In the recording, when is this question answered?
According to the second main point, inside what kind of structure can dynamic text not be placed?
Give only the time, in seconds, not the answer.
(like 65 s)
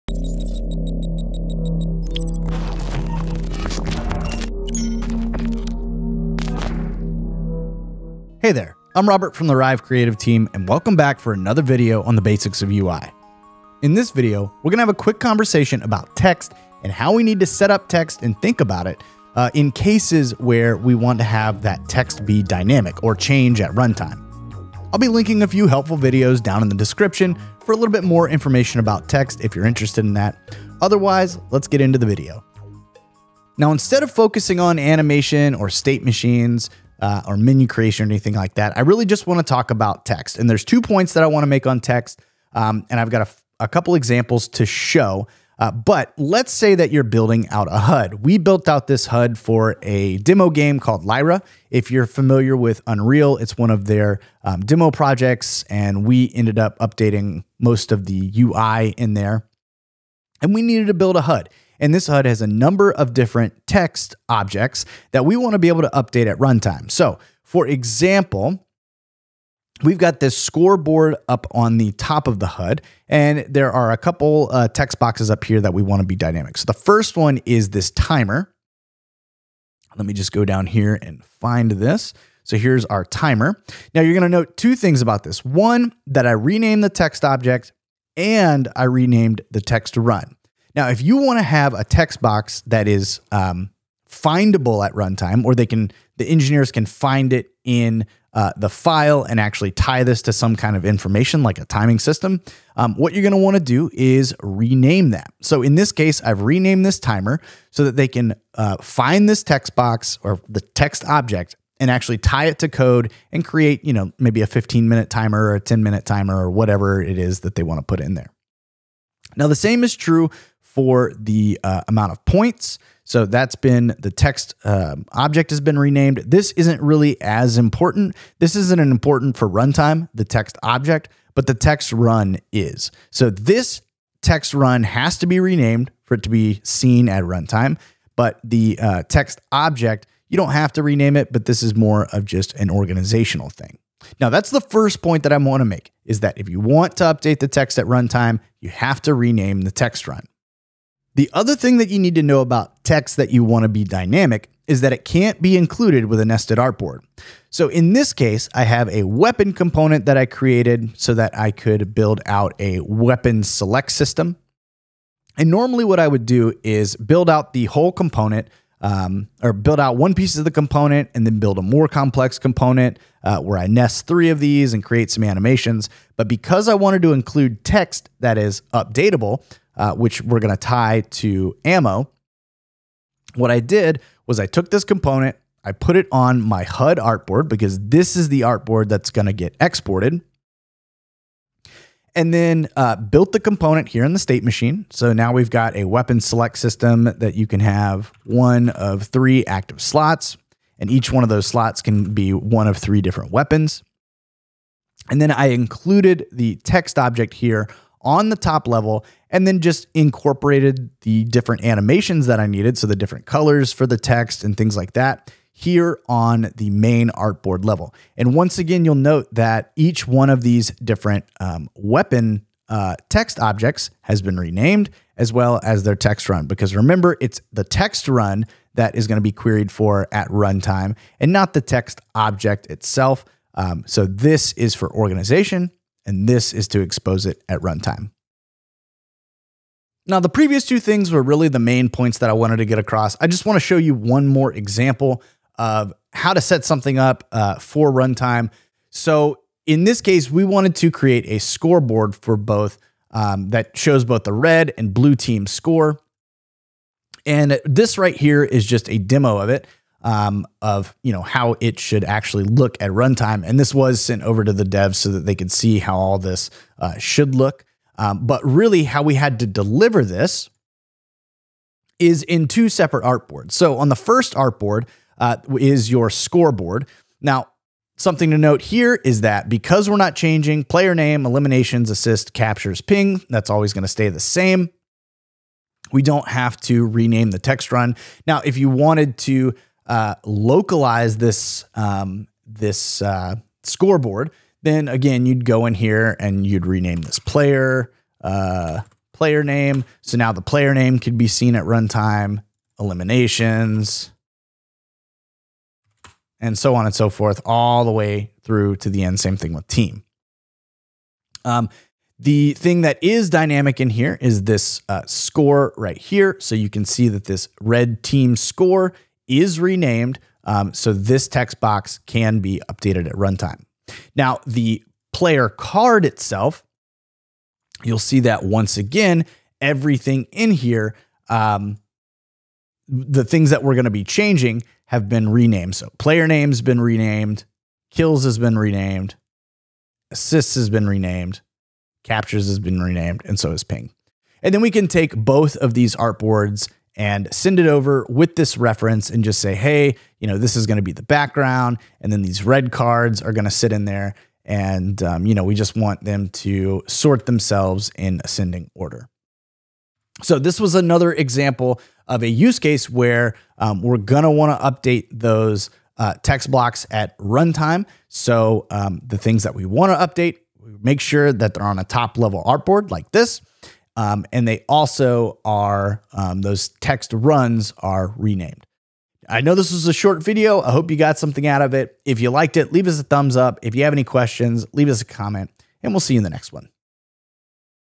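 156 s.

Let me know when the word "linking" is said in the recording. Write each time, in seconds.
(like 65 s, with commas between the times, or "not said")
25 s.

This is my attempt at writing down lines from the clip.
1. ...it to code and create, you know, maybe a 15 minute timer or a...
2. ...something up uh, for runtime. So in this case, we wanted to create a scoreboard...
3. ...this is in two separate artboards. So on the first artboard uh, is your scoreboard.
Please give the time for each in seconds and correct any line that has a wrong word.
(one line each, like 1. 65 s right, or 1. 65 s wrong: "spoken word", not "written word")
1. 112 s right
2. 246 s right
3. 270 s right.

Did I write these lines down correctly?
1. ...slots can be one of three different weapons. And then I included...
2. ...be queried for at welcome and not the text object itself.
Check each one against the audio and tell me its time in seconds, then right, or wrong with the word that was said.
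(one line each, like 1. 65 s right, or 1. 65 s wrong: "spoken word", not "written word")
1. 201 s right
2. 229 s wrong: "runtime", not "welcome".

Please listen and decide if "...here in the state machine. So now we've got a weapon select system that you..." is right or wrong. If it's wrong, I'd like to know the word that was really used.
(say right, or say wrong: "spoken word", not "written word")
right.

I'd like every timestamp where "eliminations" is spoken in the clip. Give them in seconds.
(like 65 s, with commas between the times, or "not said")
281 s, 302 s.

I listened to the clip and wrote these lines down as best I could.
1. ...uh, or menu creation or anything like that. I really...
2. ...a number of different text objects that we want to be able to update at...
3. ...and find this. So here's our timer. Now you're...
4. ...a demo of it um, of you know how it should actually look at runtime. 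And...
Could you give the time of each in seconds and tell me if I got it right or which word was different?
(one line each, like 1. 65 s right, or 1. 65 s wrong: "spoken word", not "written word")
1. 37 s right
2. 62 s right
3. 81 s right
4. 258 s right.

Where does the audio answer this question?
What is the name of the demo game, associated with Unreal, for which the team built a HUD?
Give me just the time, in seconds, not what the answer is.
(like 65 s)
51 s.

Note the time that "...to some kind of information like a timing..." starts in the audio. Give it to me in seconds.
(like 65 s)
100 s.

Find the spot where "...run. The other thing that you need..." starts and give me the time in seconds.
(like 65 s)
150 s.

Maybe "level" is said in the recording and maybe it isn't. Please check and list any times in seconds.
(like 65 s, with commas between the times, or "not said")
208 s, 217 s, 372 s.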